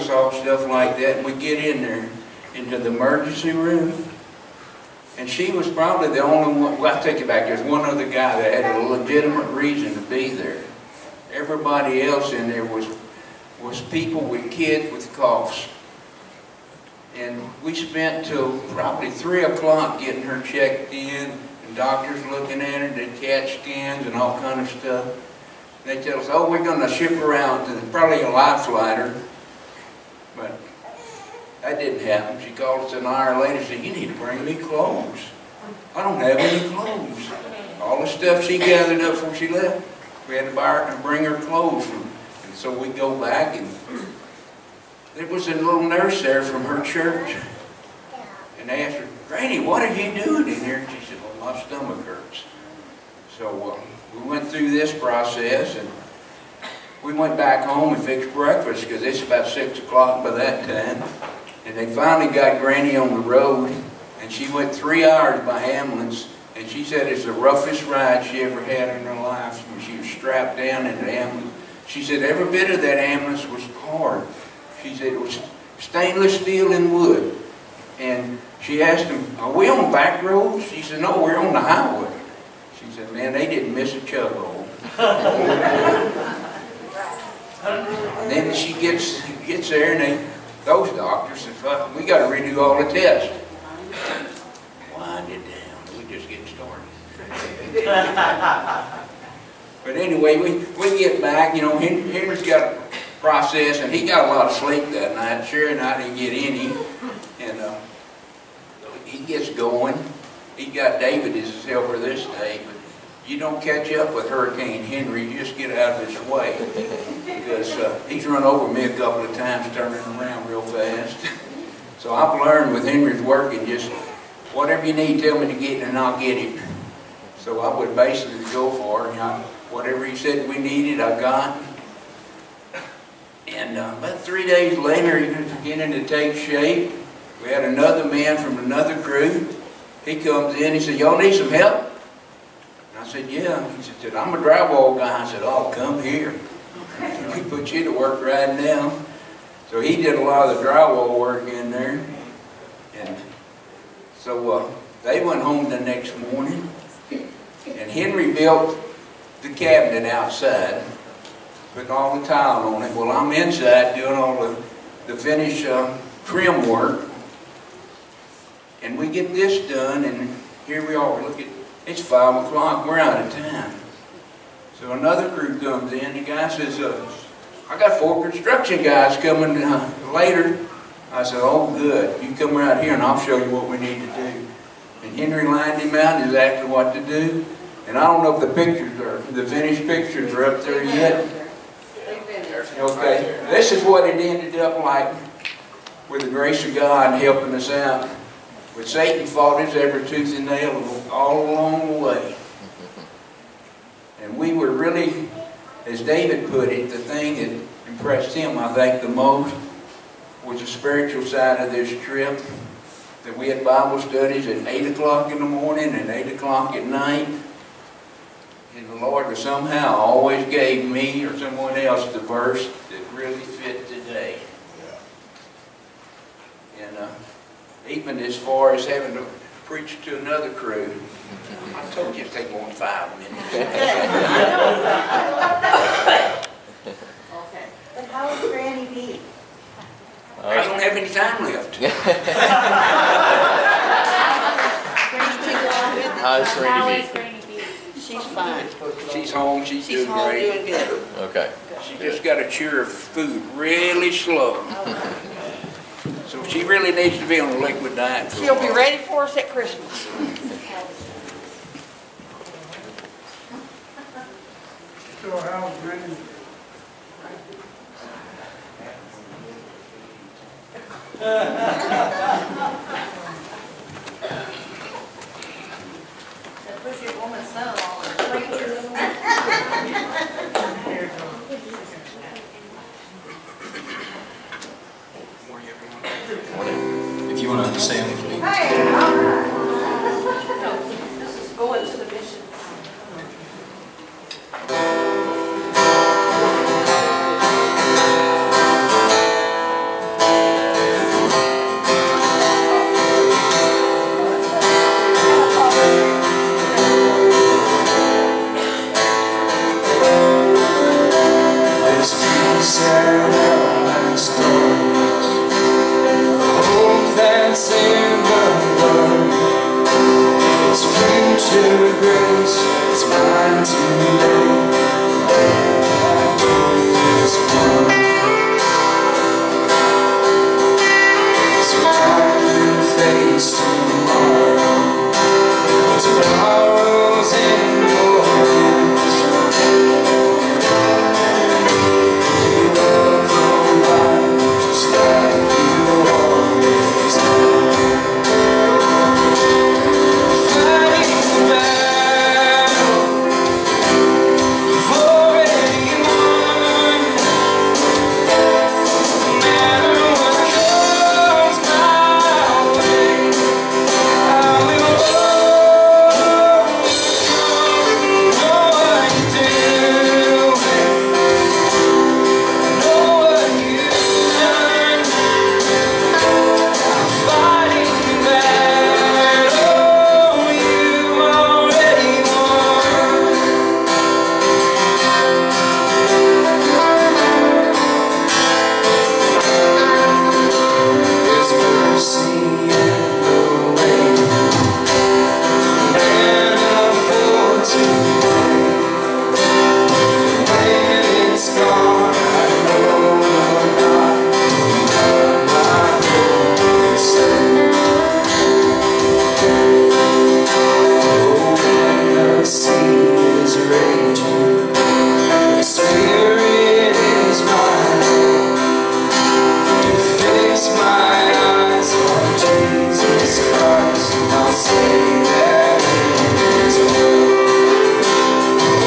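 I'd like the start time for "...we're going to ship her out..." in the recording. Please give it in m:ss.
0:26.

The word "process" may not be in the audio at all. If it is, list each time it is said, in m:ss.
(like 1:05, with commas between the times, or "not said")
0:54, 1:43.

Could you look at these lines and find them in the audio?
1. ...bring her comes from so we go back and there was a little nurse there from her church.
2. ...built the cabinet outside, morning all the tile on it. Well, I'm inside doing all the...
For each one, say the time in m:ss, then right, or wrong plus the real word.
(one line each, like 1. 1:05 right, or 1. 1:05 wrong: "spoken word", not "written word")
1. 0:41 wrong: "clothes", not "comes"
2. 2:38 wrong: "putting", not "morning".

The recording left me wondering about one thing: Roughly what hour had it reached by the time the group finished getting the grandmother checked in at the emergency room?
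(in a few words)
3 o'clock.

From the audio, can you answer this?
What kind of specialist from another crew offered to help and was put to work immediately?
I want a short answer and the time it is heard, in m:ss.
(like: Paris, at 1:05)
drywall guy, at 2:24.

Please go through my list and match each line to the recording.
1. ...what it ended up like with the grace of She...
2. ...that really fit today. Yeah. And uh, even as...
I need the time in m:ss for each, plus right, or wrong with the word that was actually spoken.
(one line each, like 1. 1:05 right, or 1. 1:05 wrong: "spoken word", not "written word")
1. 3:13 wrong: "God", not "She"
2. 3:42 right.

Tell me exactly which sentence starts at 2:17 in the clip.
We had another man from another crew.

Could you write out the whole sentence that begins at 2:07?
So I would basically go for it.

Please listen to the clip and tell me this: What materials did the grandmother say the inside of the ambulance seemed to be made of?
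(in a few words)
stainless steel and wood.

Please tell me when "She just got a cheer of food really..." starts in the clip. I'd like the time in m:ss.
4:11.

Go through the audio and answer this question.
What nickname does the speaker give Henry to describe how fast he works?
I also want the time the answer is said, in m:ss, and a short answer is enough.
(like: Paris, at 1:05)
Hurricane Henry, at 1:54.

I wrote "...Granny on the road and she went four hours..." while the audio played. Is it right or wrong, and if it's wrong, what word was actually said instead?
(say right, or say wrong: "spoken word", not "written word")
wrong: "three", not "four".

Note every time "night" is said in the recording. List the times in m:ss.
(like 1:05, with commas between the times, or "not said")
1:45, 3:36.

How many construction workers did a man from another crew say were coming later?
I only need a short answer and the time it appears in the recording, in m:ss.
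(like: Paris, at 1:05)
4, at 2:57.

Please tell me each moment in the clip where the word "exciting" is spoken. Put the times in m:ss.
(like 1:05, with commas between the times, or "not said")
not said.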